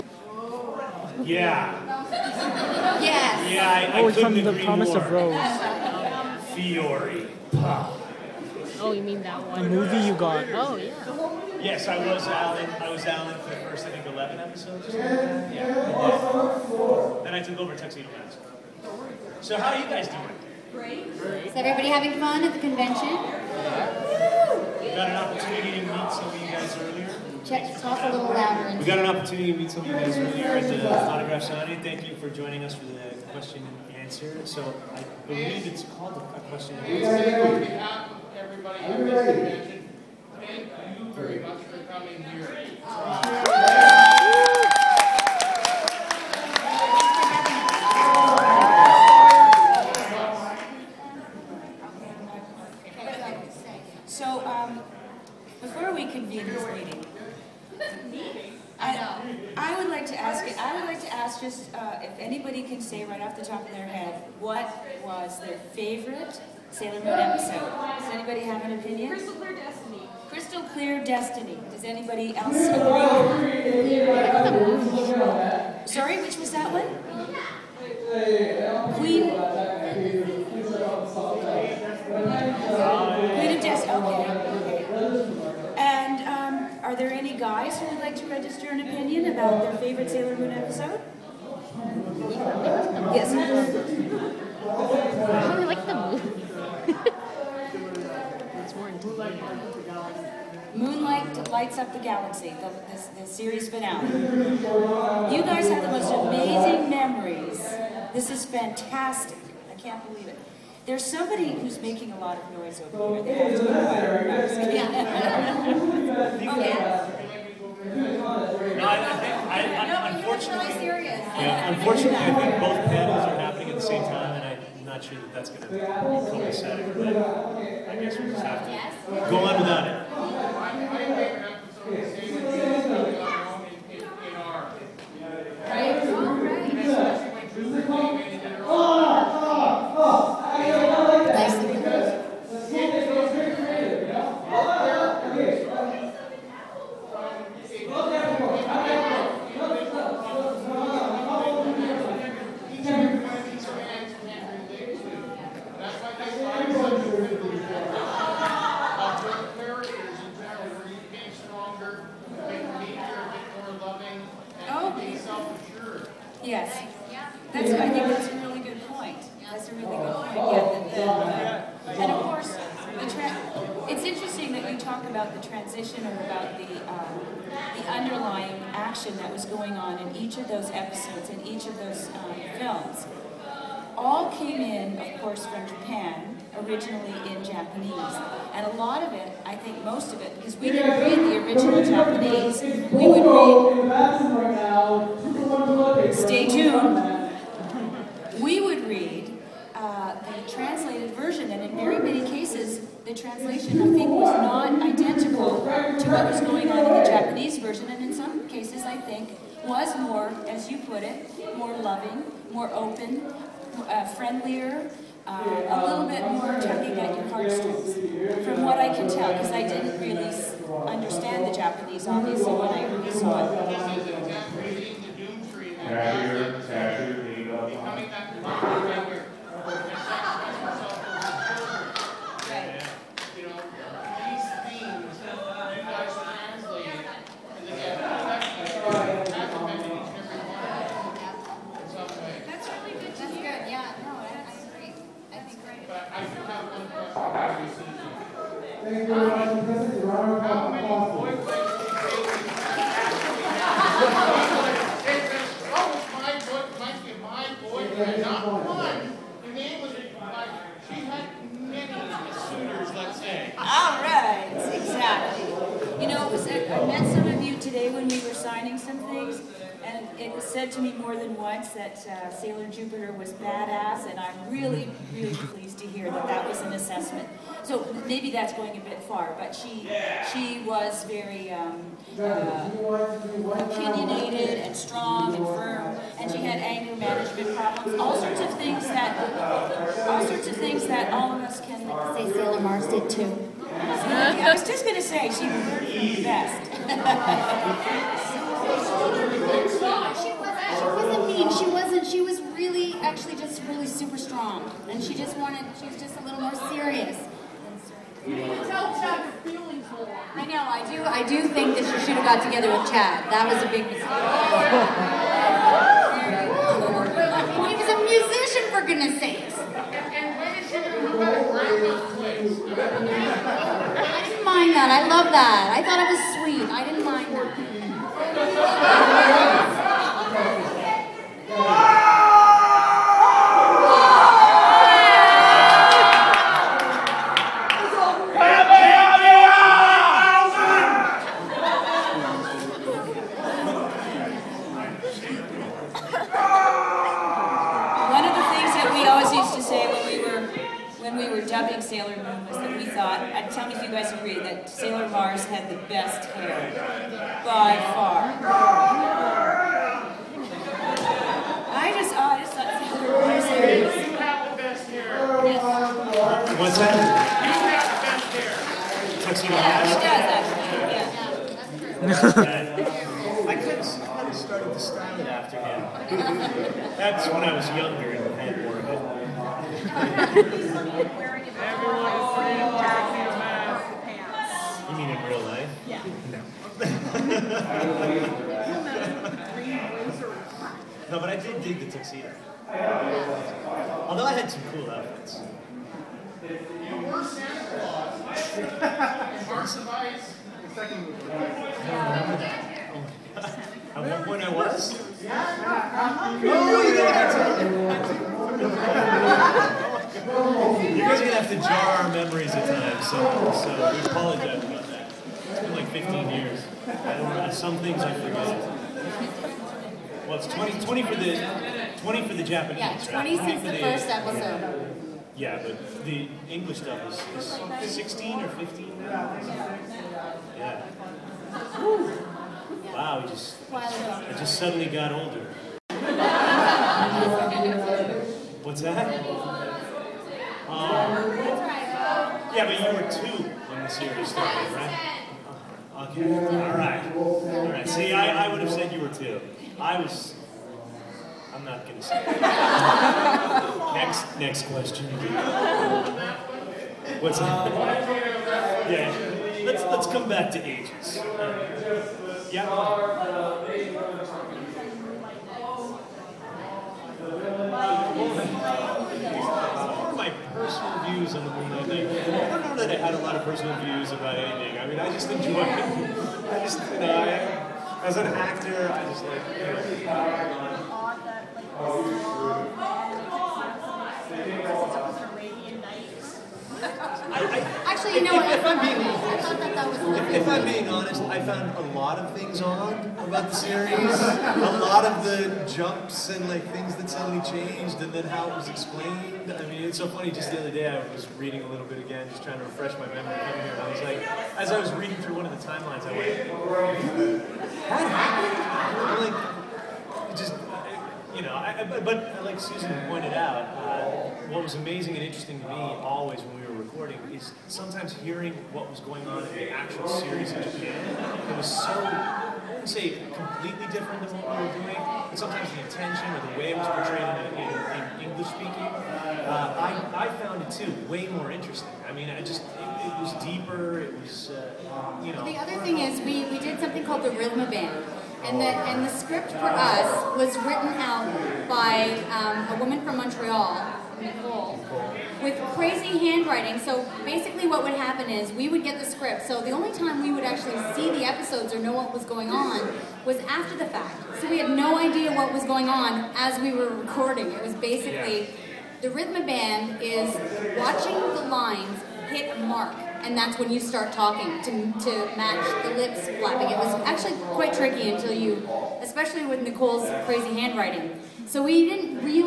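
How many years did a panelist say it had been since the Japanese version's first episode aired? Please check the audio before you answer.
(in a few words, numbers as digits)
20.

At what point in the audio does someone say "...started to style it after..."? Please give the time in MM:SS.
06:14.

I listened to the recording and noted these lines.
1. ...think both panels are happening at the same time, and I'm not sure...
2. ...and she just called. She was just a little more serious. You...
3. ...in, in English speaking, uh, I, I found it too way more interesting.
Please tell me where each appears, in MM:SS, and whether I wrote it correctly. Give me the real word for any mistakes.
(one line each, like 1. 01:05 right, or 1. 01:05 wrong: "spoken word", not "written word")
1. 02:02 right
2. 05:04 wrong: "wanted", not "called"
3. 08:47 right.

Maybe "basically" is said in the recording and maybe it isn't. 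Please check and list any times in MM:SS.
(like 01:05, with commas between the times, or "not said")
09:07, 09:17.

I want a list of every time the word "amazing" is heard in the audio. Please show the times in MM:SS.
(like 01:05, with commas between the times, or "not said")
01:46, 08:34.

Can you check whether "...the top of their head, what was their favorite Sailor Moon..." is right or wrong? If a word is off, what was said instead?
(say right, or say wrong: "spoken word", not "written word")
right.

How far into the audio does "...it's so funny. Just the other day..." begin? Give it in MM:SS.
08:19.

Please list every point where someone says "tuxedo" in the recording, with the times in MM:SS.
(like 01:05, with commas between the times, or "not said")
00:17, 06:31.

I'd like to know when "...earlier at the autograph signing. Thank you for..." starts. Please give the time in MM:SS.
00:30.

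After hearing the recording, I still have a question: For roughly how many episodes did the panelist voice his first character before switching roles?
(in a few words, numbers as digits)
11.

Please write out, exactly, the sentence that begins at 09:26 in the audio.
It was actually quite tricky until you, especially with Nicole's crazy handwriting.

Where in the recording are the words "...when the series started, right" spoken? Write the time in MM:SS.
07:23.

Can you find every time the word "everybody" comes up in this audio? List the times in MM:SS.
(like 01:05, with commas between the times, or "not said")
00:21, 00:38.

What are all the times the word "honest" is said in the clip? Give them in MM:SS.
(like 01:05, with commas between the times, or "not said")
08:10.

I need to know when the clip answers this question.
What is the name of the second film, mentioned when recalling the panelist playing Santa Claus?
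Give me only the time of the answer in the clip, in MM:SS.
06:39.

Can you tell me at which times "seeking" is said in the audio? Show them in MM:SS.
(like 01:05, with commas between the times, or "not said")
not said.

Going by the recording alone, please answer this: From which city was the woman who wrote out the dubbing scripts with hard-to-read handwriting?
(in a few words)
Montreal.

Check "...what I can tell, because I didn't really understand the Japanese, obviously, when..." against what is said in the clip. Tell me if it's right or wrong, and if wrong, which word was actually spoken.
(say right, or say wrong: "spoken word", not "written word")
right.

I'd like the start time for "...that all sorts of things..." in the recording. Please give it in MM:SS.
04:48.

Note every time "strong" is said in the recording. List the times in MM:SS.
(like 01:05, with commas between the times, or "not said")
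04:44, 05:04.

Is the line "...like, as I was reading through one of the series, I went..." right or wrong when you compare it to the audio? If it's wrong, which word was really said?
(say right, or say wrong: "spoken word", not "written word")
wrong: "timelines", not "series".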